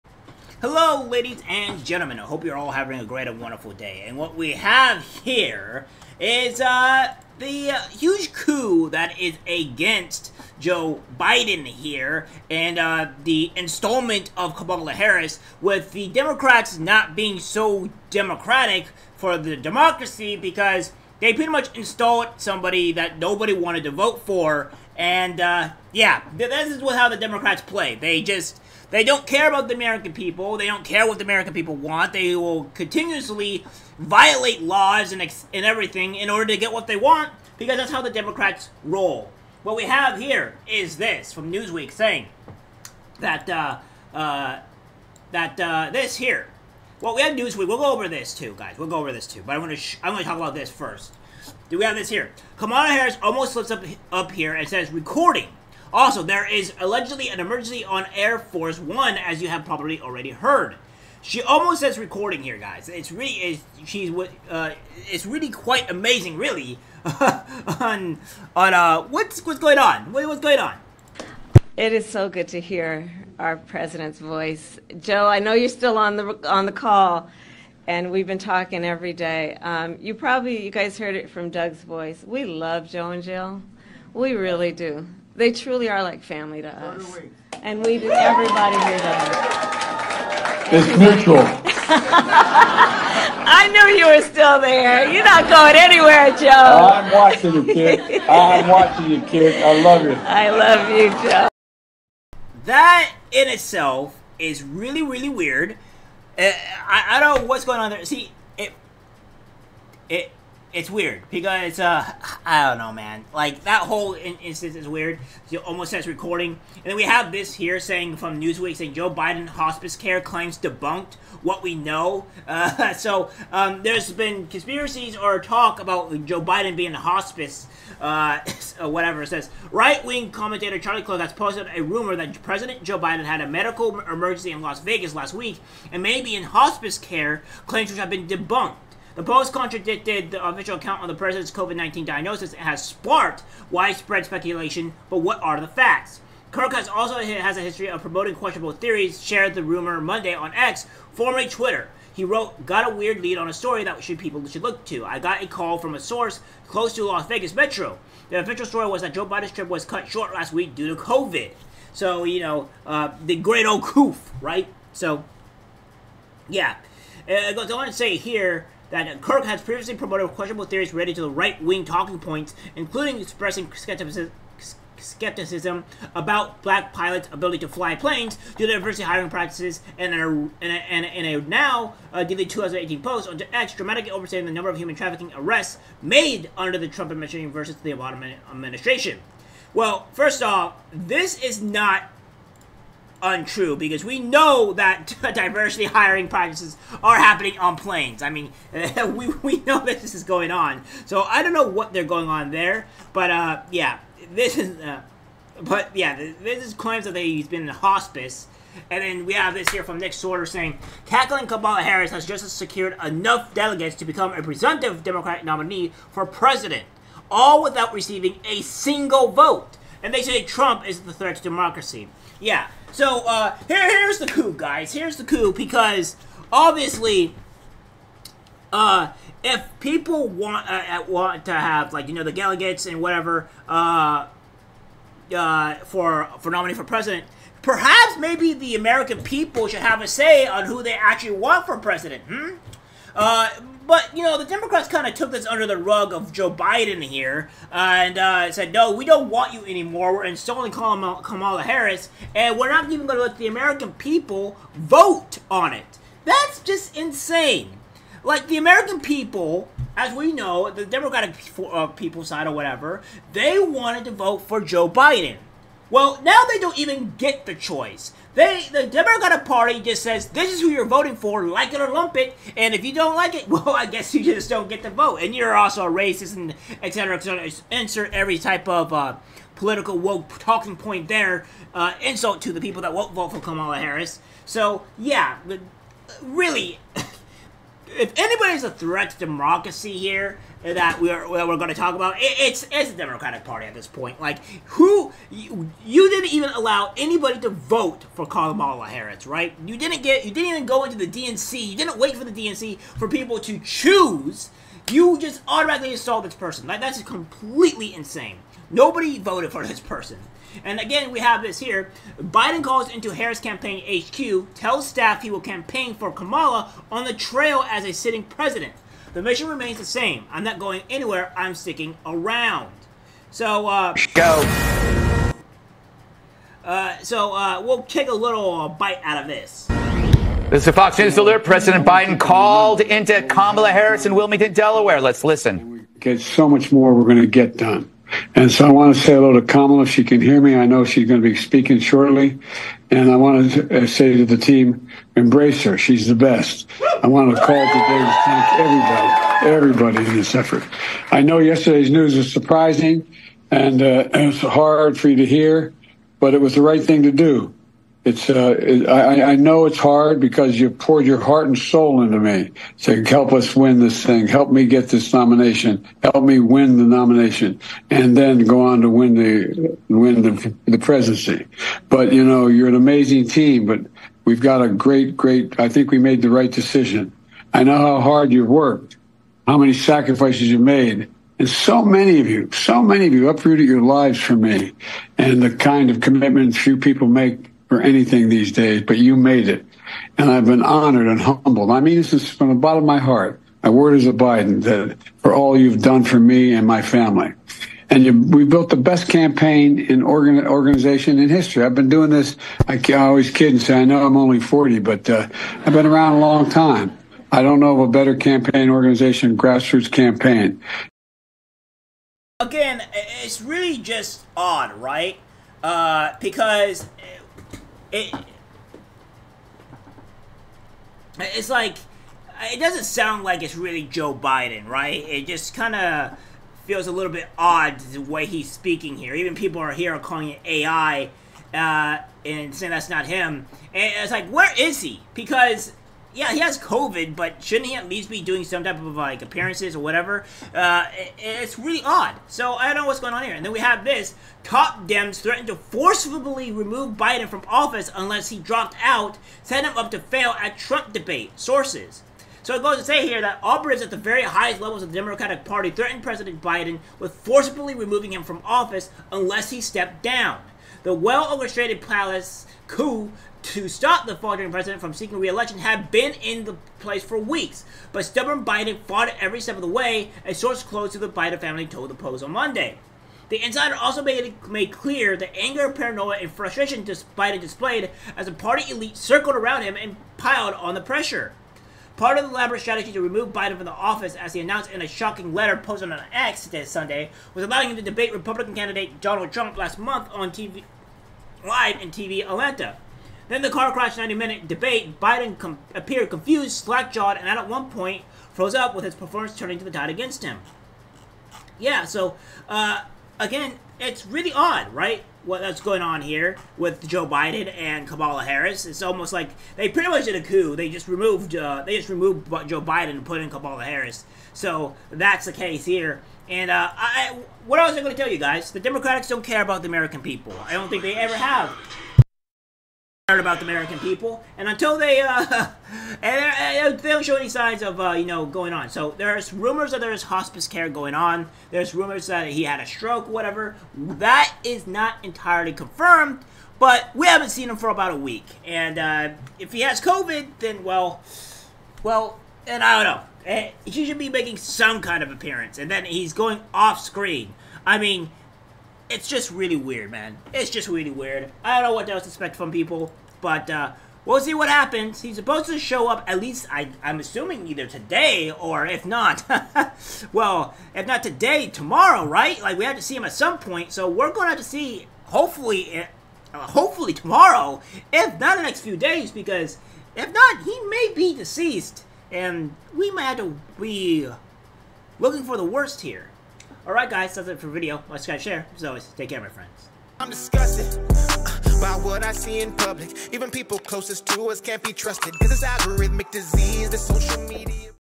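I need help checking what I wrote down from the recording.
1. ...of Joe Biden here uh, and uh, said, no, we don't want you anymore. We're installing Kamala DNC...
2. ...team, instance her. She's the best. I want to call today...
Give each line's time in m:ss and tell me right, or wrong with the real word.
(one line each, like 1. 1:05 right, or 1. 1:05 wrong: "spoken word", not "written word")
1. 4:06 wrong: "Harris", not "DNC"
2. 5:44 wrong: "embrace", not "instance".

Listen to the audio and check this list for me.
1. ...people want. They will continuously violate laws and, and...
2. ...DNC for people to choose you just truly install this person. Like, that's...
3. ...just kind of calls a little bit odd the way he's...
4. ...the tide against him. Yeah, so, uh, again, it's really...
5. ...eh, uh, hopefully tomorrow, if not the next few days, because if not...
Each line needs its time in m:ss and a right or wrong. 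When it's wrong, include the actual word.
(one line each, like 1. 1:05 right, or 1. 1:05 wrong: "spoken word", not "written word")
1. 0:31 right
2. 5:02 wrong: "automatically", not "truly"
3. 7:05 wrong: "feels", not "calls"
4. 8:19 right
5. 9:25 right.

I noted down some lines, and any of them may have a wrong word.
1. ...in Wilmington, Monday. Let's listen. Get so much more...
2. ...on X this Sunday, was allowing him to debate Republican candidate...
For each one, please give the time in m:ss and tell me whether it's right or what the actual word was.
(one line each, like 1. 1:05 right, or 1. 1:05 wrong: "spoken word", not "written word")
1. 5:34 wrong: "Delaware", not "Monday"
2. 8:05 right.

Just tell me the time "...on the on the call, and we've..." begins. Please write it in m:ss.
1:15.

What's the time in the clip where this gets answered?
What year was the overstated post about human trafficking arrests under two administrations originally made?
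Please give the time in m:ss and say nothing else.
3:02.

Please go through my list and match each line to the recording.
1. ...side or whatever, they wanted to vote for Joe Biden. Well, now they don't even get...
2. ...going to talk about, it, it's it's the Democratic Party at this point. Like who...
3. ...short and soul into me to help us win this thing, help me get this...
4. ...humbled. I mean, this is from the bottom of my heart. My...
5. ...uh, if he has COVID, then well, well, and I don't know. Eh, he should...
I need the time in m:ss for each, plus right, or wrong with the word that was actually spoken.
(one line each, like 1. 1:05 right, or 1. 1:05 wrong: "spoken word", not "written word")
1. 4:22 right
2. 4:51 right
3. 6:01 wrong: "heart", not "short"
4. 6:31 right
5. 8:58 right.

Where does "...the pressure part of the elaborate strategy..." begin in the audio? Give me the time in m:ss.
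8:00.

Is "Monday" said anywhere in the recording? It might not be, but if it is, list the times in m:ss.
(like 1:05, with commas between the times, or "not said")
2:30, 7:52.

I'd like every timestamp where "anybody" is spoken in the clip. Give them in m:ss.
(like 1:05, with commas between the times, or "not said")
4:48, 4:56.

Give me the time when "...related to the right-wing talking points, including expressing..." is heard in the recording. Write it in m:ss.
2:50.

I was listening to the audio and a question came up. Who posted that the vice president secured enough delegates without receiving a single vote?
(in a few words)
Nick Sortor.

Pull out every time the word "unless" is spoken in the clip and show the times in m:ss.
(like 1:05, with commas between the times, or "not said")
7:27, 7:39.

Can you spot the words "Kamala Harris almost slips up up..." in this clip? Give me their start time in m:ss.
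0:52.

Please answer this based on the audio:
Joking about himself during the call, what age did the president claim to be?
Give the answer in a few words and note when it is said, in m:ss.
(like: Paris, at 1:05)
40, at 6:44.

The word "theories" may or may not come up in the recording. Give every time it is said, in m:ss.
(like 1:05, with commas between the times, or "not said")
2:28, 2:50.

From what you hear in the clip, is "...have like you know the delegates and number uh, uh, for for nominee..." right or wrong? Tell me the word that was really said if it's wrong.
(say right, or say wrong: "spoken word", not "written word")
wrong: "whatever", not "number".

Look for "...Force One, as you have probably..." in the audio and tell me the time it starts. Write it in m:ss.
0:58.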